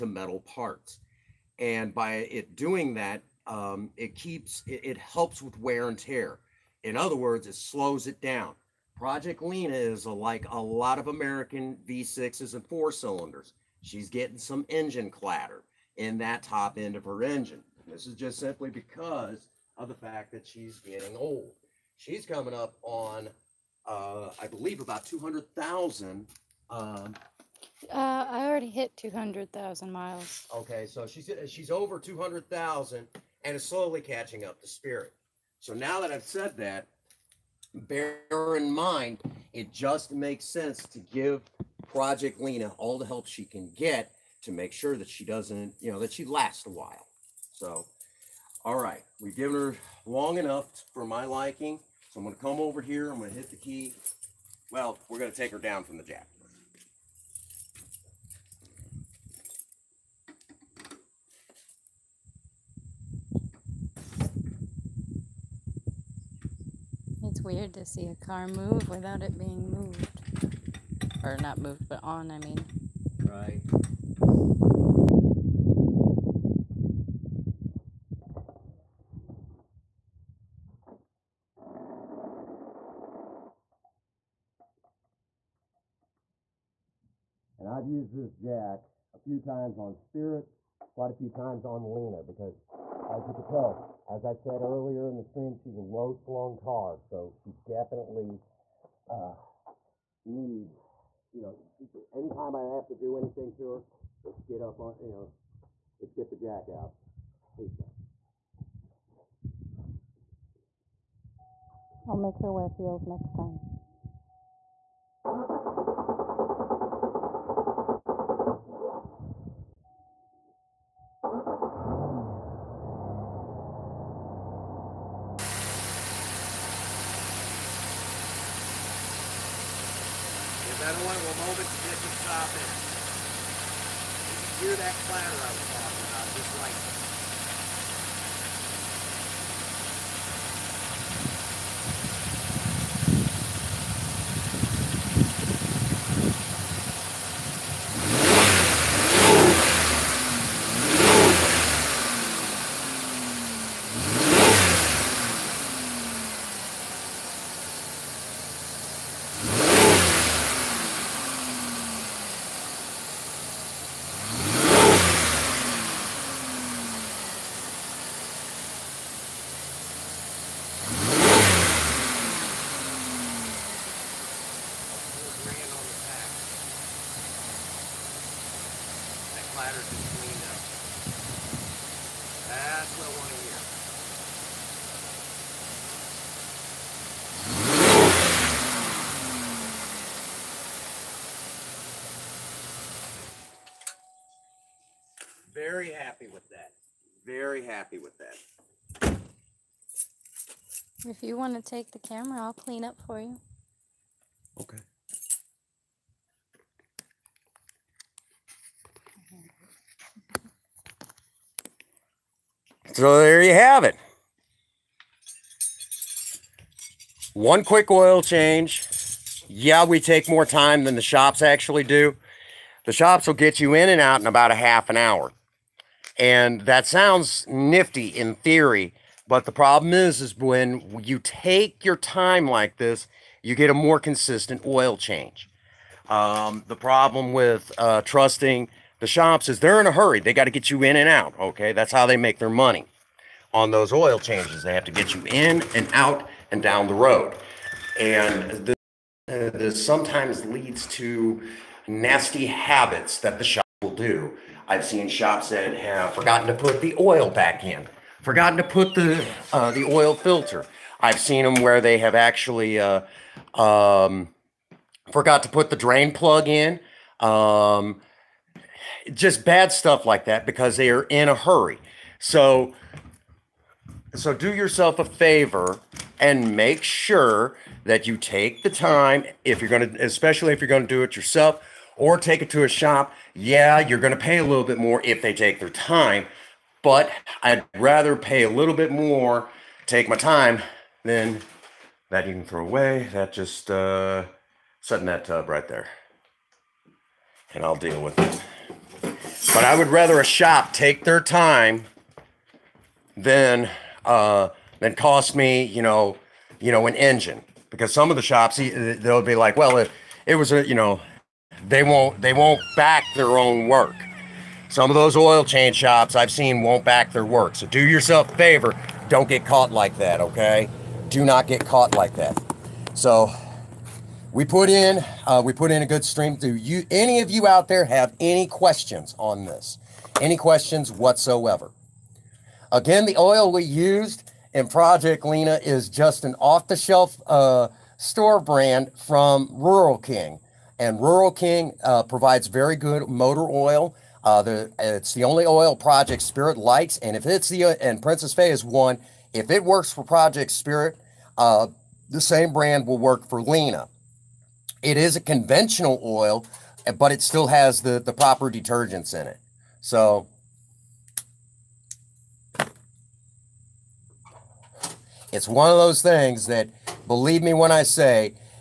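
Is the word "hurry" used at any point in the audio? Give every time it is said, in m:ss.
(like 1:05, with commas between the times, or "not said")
3:59, 4:31.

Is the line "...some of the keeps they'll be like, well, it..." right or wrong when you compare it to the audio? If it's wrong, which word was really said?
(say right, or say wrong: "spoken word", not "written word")
wrong: "shops", not "keeps".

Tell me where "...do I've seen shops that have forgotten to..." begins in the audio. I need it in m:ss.
4:13.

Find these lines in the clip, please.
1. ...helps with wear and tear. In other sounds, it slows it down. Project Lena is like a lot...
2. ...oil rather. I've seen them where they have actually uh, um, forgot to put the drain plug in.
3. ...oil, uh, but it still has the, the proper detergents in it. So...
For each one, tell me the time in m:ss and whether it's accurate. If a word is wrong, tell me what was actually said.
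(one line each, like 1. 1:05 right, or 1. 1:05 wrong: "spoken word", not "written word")
1. 0:04 wrong: "words", not "sounds"
2. 4:19 wrong: "filter", not "rather"
3. 5:56 right.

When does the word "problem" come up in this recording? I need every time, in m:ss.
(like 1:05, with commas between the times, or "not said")
3:49, 3:56.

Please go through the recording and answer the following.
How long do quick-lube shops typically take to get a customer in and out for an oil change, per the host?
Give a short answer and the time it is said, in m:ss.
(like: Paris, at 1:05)
half an hour, at 3:44.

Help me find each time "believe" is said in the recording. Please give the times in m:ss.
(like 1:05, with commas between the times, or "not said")
0:24, 6:07.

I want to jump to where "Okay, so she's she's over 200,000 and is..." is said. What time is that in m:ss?
0:30.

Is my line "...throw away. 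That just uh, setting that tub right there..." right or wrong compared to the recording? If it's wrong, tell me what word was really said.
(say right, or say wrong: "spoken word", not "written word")
right.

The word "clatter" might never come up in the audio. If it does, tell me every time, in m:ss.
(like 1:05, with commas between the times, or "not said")
0:15, 2:15.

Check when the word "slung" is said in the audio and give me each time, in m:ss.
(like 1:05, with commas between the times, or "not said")
1:36.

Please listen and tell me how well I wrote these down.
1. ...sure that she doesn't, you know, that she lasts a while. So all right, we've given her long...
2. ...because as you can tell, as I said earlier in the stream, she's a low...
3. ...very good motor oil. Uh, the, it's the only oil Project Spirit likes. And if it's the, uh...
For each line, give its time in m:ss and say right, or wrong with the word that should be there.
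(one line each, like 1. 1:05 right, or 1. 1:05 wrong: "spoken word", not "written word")
1. 0:44 right
2. 1:32 right
3. 5:42 right.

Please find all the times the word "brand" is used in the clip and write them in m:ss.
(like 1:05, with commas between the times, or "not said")
5:38, 5:52.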